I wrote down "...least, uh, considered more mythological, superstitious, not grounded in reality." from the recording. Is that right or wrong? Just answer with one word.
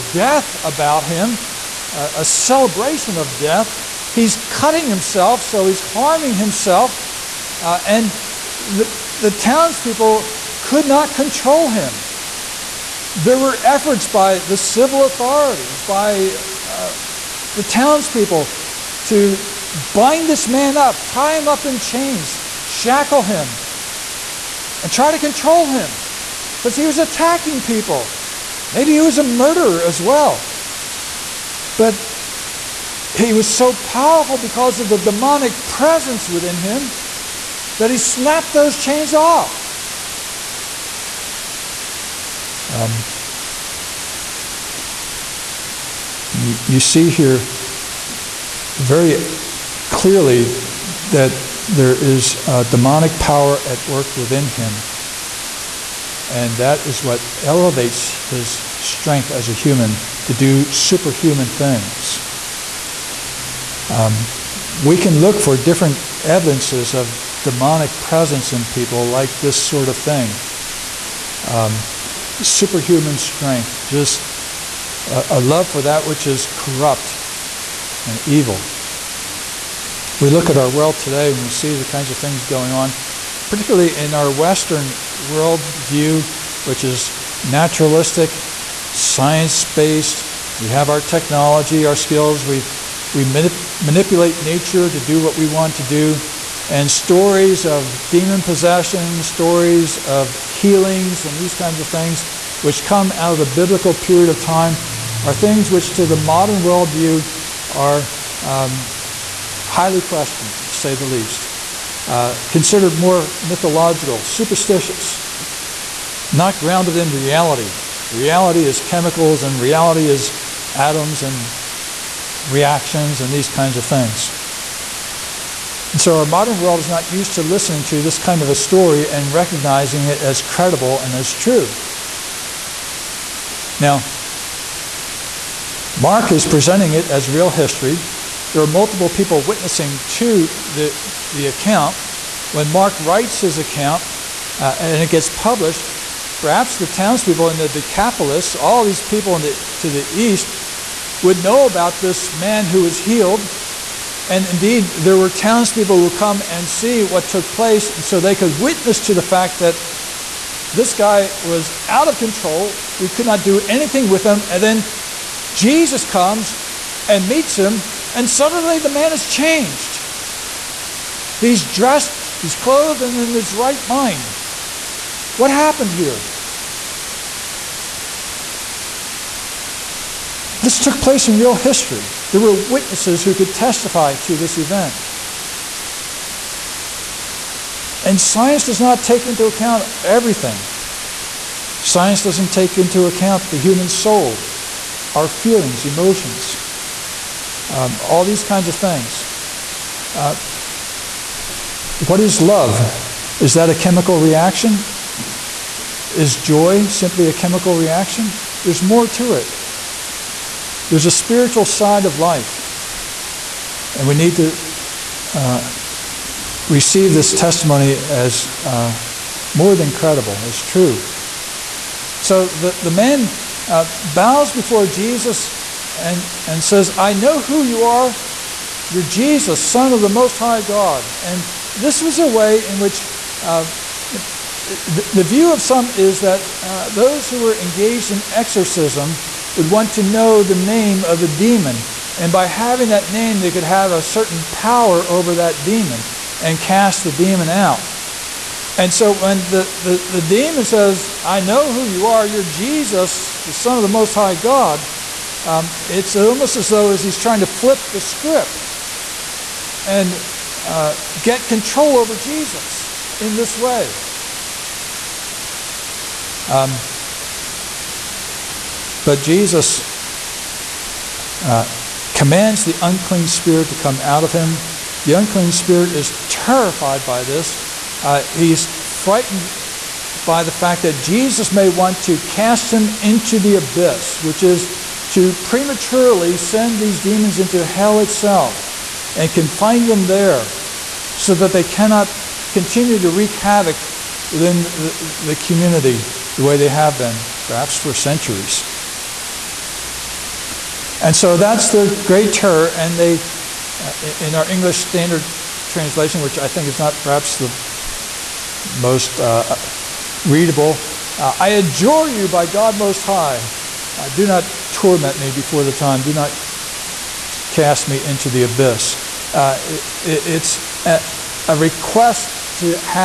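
right.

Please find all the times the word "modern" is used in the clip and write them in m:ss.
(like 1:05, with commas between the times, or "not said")
1:46, 2:06.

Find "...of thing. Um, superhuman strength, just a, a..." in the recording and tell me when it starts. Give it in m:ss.
1:09.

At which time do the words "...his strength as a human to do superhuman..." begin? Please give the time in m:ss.
0:58.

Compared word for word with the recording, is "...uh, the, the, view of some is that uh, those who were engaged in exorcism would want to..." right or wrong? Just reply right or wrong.
right.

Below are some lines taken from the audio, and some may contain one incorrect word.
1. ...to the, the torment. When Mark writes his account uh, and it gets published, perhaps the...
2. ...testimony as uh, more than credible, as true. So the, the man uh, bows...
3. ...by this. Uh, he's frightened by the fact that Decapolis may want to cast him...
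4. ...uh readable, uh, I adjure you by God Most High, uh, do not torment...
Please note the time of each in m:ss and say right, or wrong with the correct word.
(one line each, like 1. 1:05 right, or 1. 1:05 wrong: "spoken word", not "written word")
1. 2:20 wrong: "account", not "torment"
2. 3:37 right
3. 4:37 wrong: "Jesus", not "Decapolis"
4. 5:09 right.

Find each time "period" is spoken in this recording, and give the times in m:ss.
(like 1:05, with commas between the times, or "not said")
1:43.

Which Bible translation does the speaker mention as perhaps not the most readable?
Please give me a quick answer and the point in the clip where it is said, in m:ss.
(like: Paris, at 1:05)
English Standard Translation, at 5:04.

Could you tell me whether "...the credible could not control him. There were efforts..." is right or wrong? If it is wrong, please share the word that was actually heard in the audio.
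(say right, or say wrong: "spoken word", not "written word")
wrong: "townspeople", not "credible".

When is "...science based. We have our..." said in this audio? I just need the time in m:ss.
1:28.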